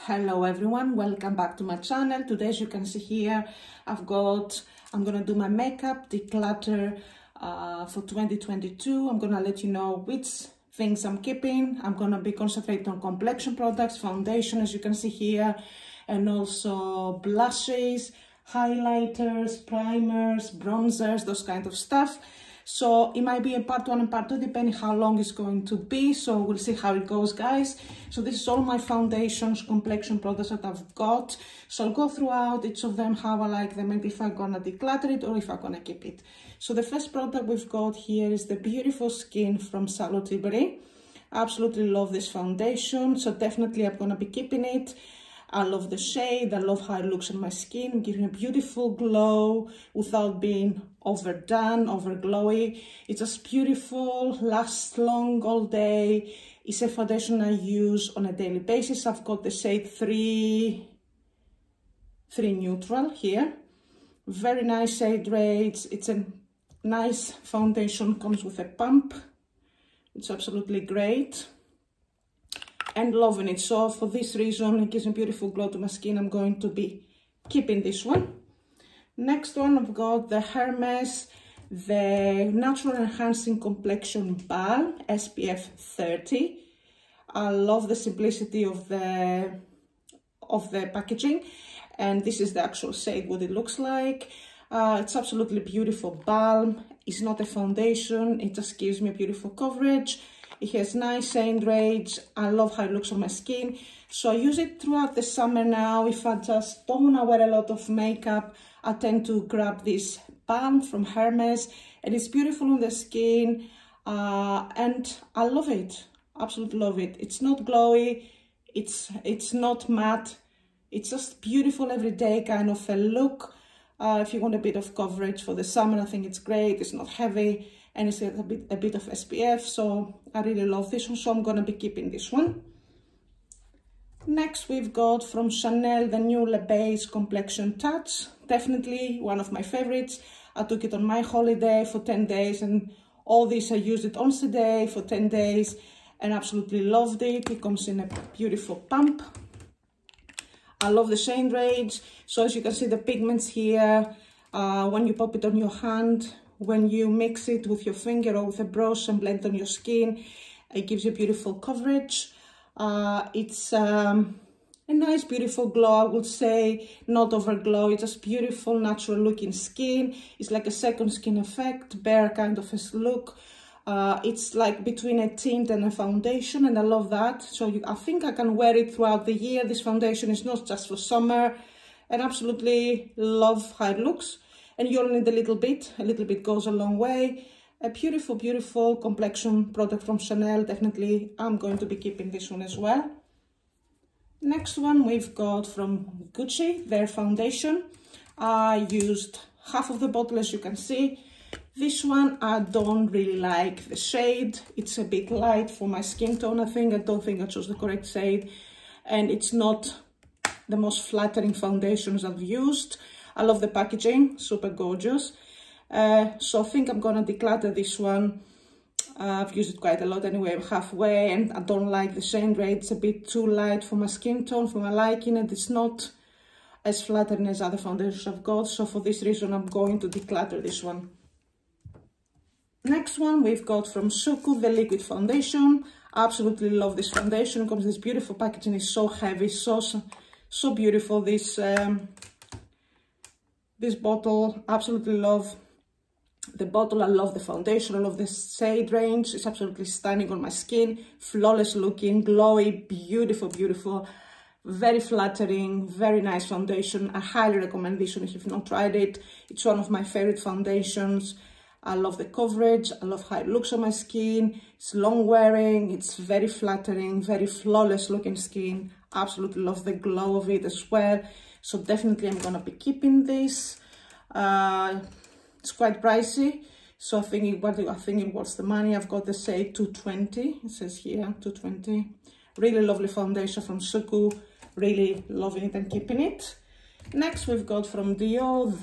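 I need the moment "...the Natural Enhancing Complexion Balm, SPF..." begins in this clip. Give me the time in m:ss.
1:21.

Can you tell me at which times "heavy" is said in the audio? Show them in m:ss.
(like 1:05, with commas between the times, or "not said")
2:07, 3:59.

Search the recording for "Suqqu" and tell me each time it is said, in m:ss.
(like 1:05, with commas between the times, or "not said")
3:54, 4:43.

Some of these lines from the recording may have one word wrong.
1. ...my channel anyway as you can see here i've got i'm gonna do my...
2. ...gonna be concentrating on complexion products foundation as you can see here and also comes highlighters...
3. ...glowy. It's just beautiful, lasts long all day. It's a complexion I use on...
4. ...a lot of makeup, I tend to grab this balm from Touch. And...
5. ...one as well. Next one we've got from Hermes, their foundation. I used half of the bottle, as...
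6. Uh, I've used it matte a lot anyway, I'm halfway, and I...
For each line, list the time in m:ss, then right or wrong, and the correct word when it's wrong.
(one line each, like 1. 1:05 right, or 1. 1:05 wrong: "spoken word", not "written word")
1. 0:01 wrong: "today", not "anyway"
2. 0:11 wrong: "blushes", not "comes"
3. 0:52 wrong: "foundation", not "complexion"
4. 1:47 wrong: "Hermes", not "Touch"
5. 3:12 wrong: "Gucci", not "Hermes"
6. 3:39 wrong: "quite", not "matte".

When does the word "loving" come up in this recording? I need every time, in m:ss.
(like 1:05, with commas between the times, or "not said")
1:13, 4:45.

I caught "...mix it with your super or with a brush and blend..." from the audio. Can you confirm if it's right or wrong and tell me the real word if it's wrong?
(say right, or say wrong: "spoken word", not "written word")
wrong: "finger", not "super".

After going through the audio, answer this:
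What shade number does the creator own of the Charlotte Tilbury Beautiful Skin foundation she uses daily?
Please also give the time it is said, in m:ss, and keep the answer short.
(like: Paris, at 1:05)
3 Neutral, at 1:02.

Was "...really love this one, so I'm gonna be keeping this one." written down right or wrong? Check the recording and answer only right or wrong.
right.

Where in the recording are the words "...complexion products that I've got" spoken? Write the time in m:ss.
0:29.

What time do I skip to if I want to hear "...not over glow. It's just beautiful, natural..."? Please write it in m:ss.
2:47.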